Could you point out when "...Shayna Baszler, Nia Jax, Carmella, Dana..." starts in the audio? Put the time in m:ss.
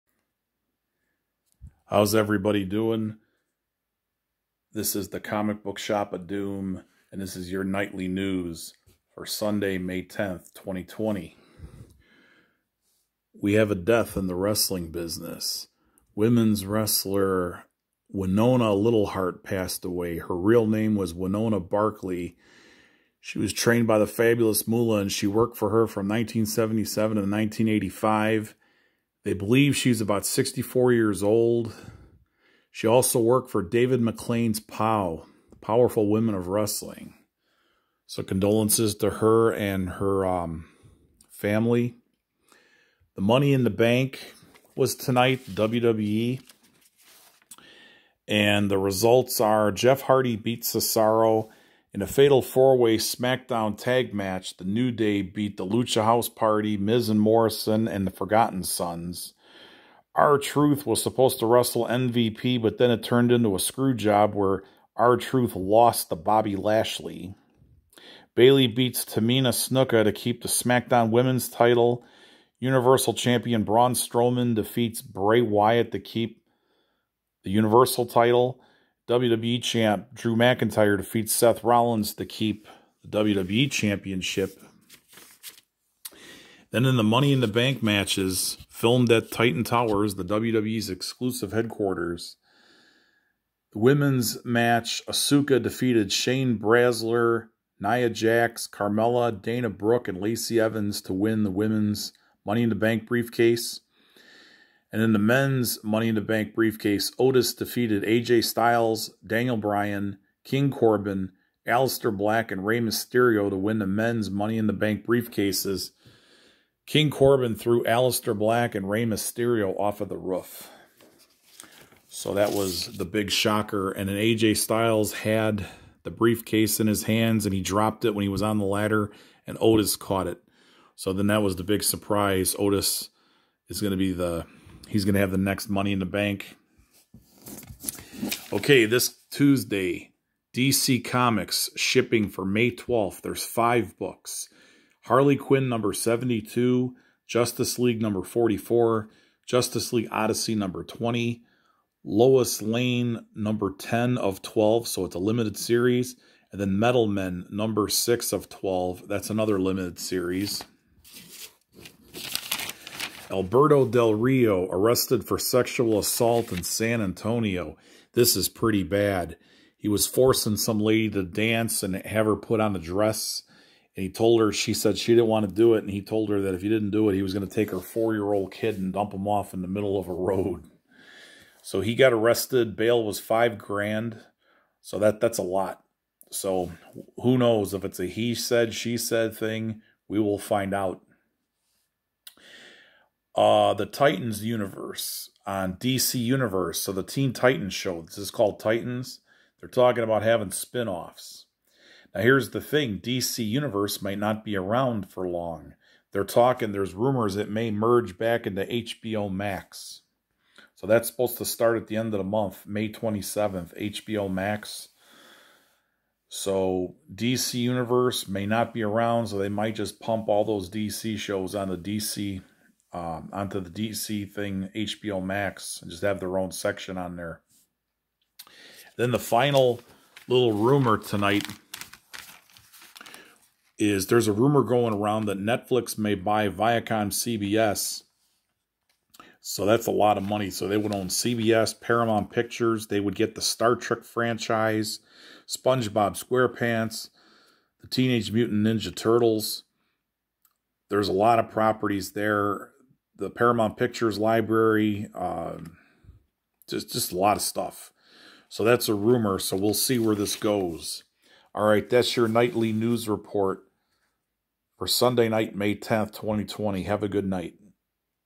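1:36.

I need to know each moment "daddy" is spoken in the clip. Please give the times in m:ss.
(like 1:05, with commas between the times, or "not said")
not said.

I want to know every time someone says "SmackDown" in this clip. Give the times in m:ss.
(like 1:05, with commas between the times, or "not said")
0:52, 1:10.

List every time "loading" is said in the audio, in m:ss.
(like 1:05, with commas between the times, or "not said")
not said.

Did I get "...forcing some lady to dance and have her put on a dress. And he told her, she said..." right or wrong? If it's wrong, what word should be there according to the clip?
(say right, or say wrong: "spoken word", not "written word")
right.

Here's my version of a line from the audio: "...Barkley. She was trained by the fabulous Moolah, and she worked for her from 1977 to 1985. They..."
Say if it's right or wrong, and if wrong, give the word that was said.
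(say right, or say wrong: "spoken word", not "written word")
right.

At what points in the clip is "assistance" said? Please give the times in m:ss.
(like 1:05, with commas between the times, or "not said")
not said.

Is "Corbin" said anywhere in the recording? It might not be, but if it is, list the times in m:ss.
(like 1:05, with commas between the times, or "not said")
1:50, 1:57.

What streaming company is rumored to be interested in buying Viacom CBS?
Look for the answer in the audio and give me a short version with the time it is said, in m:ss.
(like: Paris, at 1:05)
Netflix, at 3:55.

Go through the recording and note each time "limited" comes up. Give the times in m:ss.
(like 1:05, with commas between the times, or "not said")
2:35, 2:39.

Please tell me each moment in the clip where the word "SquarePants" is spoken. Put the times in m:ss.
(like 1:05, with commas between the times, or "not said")
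4:06.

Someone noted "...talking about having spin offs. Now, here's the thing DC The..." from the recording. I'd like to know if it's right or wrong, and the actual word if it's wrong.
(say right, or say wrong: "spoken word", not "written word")
wrong: "Universe", not "The".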